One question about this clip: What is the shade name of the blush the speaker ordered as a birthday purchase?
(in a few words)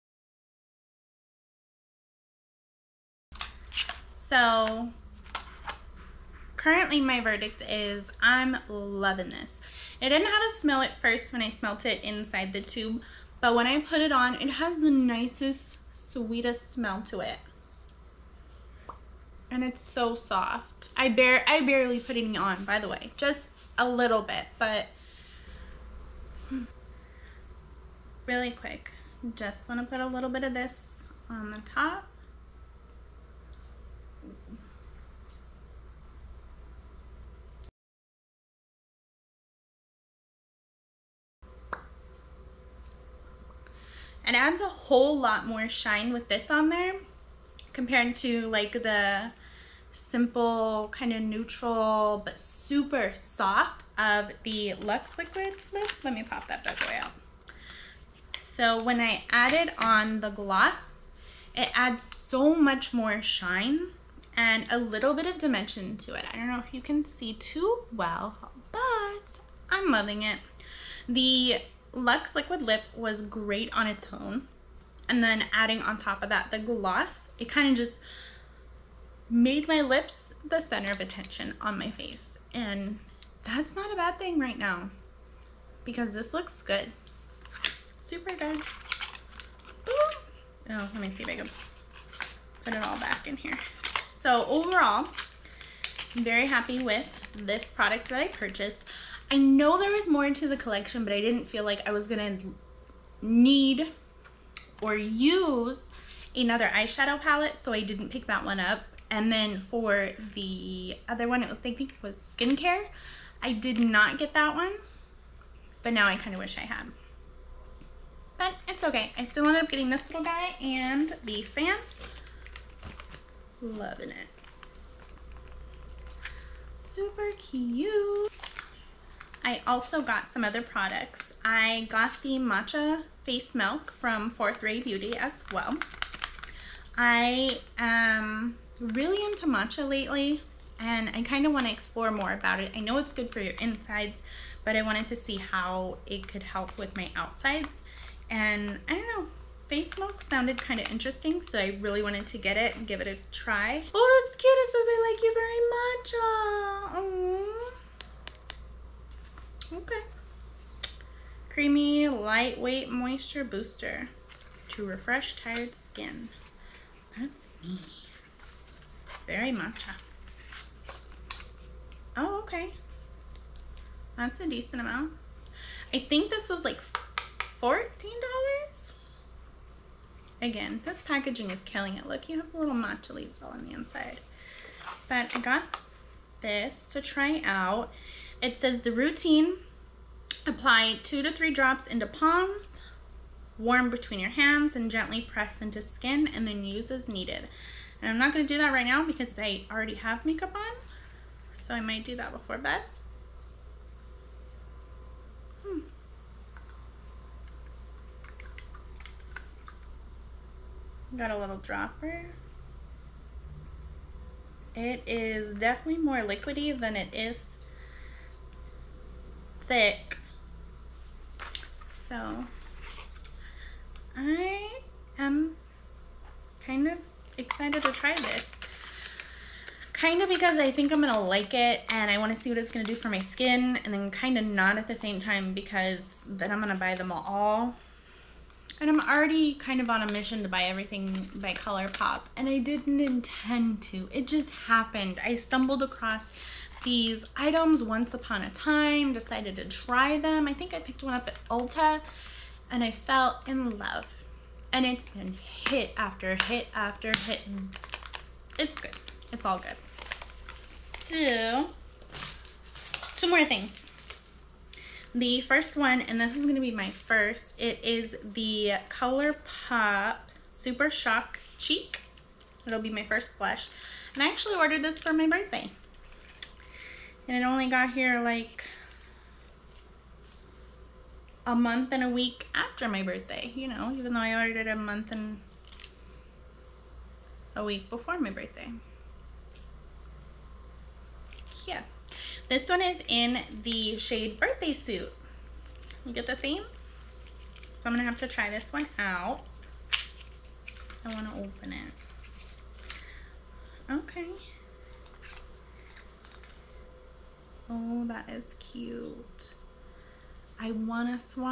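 Birthday Suit.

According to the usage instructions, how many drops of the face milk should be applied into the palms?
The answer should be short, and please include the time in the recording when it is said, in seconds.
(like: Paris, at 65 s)
2 to 3, at 191 s.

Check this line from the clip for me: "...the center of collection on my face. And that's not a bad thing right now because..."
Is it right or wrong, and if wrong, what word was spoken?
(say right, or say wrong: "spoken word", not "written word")
wrong: "attention", not "collection".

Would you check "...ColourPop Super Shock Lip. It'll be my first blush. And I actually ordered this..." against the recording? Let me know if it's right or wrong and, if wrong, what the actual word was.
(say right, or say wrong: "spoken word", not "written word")
wrong: "Cheek", not "Lip".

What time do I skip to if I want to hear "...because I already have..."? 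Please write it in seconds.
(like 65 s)
199 s.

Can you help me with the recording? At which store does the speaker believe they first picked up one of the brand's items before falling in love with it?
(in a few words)
Ulta.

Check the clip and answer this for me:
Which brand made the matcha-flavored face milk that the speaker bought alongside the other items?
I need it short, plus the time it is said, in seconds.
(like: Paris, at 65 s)
Fourth Ray Beauty, at 134 s.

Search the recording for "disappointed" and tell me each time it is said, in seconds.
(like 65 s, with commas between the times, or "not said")
not said.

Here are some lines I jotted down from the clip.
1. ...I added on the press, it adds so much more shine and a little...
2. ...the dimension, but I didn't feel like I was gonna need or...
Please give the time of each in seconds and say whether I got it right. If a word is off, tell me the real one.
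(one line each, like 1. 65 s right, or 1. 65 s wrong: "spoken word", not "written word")
1. 58 s wrong: "gloss", not "press"
2. 100 s wrong: "collection", not "dimension".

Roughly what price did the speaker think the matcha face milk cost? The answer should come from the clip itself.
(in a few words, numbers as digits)
$14.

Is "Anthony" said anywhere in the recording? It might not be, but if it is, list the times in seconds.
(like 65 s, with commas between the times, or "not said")
not said.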